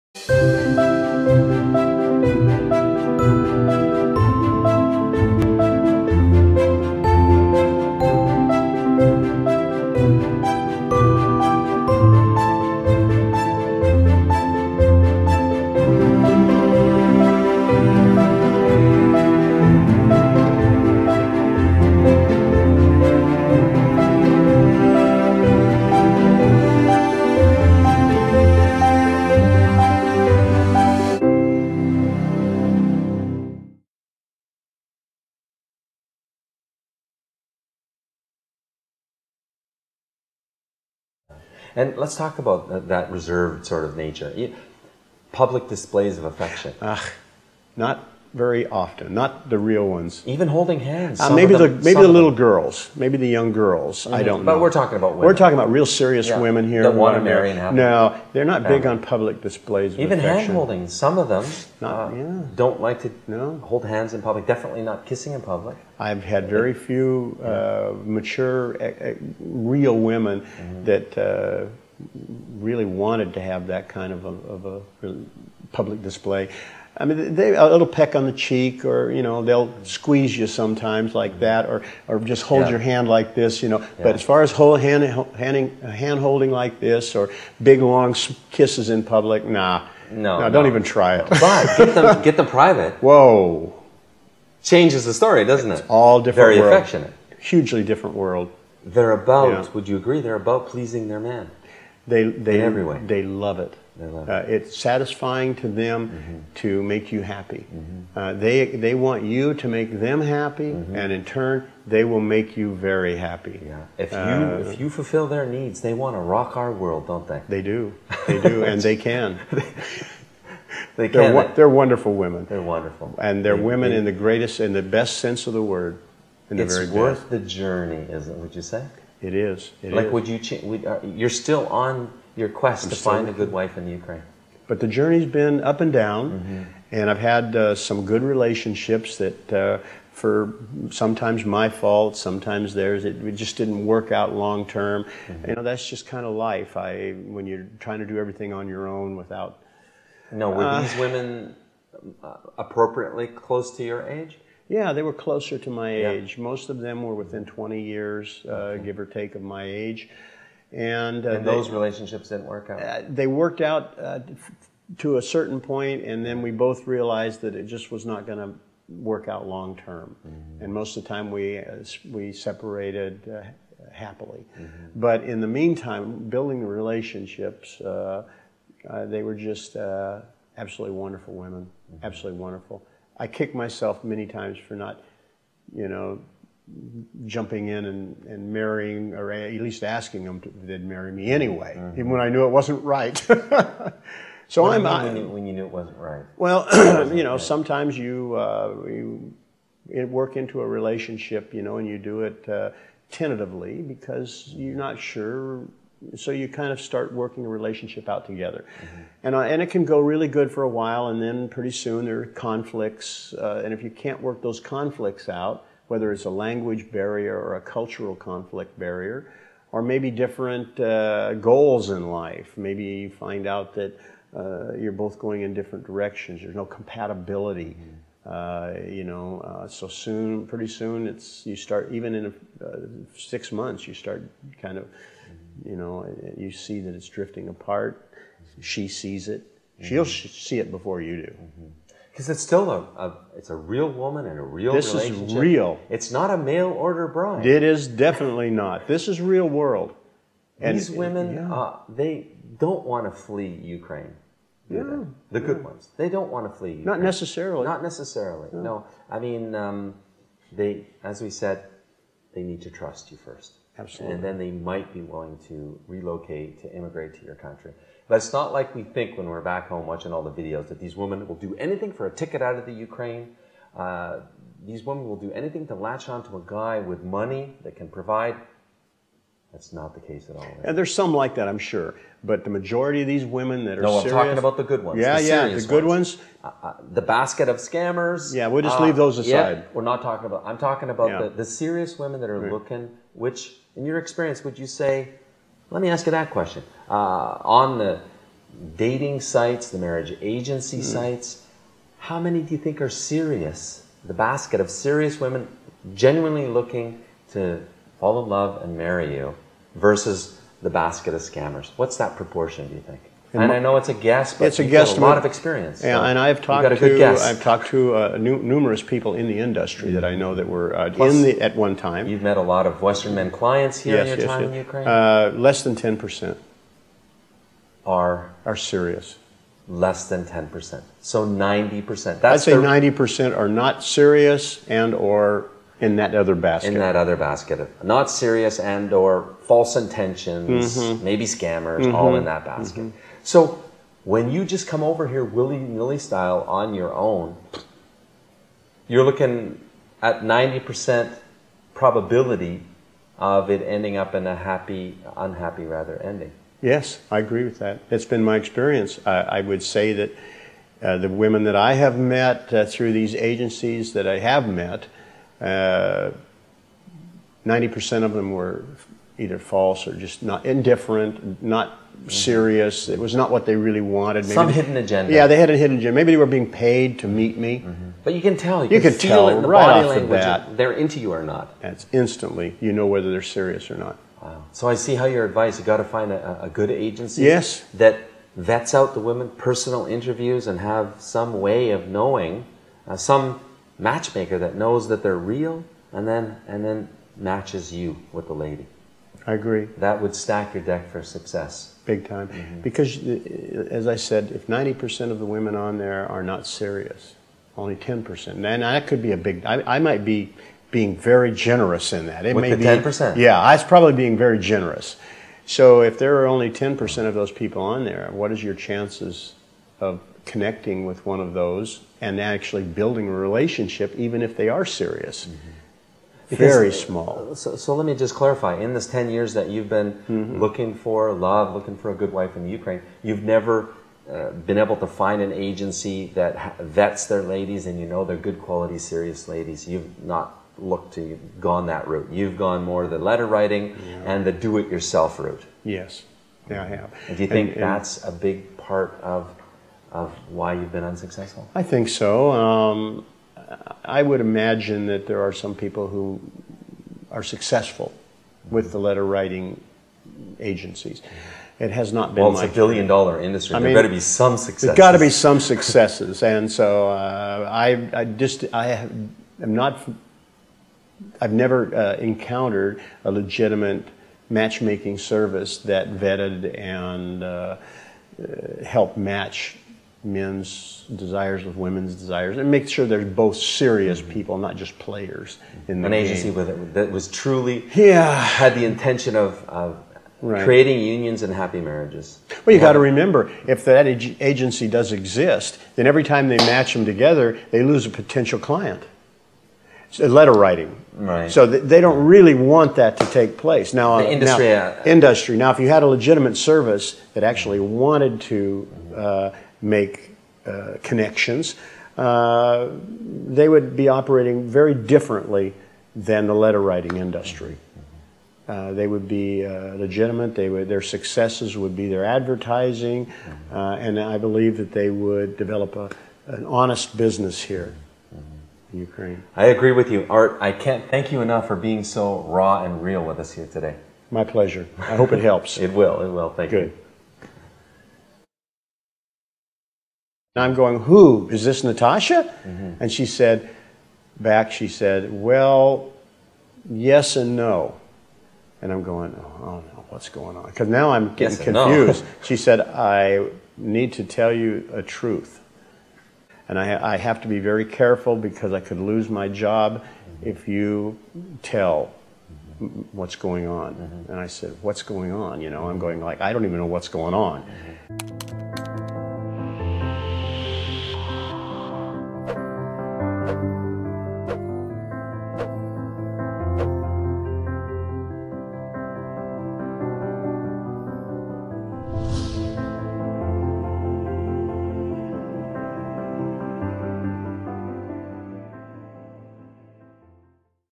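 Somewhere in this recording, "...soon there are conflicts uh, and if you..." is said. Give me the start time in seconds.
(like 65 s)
211 s.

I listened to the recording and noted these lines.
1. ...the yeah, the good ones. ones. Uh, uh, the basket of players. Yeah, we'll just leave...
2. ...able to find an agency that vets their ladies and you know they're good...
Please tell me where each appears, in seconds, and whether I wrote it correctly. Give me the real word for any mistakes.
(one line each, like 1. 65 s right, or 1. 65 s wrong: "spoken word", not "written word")
1. 285 s wrong: "scammers", not "players"
2. 434 s right.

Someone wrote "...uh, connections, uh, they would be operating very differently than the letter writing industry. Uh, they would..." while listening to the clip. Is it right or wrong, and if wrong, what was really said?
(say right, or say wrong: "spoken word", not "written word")
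right.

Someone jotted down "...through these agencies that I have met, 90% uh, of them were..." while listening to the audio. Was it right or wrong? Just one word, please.
right.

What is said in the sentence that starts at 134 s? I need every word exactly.
But the journey's been up and down, mm-hmm.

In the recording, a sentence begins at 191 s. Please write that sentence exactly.
even when I knew it wasn't right.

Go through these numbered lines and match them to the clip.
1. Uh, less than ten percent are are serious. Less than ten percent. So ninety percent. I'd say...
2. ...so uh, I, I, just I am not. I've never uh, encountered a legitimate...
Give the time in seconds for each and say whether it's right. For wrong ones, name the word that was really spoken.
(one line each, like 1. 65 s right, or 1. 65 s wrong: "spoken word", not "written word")
1. 324 s right
2. 466 s right.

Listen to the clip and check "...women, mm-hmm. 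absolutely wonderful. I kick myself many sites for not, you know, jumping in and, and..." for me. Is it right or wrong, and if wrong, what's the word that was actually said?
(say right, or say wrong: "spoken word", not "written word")
wrong: "times", not "sites".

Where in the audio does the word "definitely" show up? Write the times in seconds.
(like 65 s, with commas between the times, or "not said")
64 s, 247 s.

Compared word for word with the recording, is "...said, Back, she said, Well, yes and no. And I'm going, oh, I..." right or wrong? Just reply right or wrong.
right.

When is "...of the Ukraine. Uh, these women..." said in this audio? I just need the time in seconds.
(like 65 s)
272 s.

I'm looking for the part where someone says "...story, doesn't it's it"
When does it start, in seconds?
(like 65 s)
95 s.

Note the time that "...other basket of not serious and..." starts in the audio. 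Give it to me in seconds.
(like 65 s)
336 s.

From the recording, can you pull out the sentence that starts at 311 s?
What's that proportion, do you think?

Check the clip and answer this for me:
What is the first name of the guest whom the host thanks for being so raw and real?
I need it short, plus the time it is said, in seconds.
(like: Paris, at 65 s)
Art, at 530 s.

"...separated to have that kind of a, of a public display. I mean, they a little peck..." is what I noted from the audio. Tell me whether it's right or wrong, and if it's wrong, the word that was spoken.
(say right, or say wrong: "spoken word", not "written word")
wrong: "wanted", not "separated".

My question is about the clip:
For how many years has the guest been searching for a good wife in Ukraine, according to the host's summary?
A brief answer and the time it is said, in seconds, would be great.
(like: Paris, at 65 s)
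10 years, at 428 s.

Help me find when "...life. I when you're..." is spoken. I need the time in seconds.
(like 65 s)
146 s.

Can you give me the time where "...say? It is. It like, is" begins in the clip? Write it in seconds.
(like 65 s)
128 s.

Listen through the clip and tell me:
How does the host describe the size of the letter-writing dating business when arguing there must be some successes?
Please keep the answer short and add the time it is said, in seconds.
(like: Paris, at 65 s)
billion dollar industry, at 462 s.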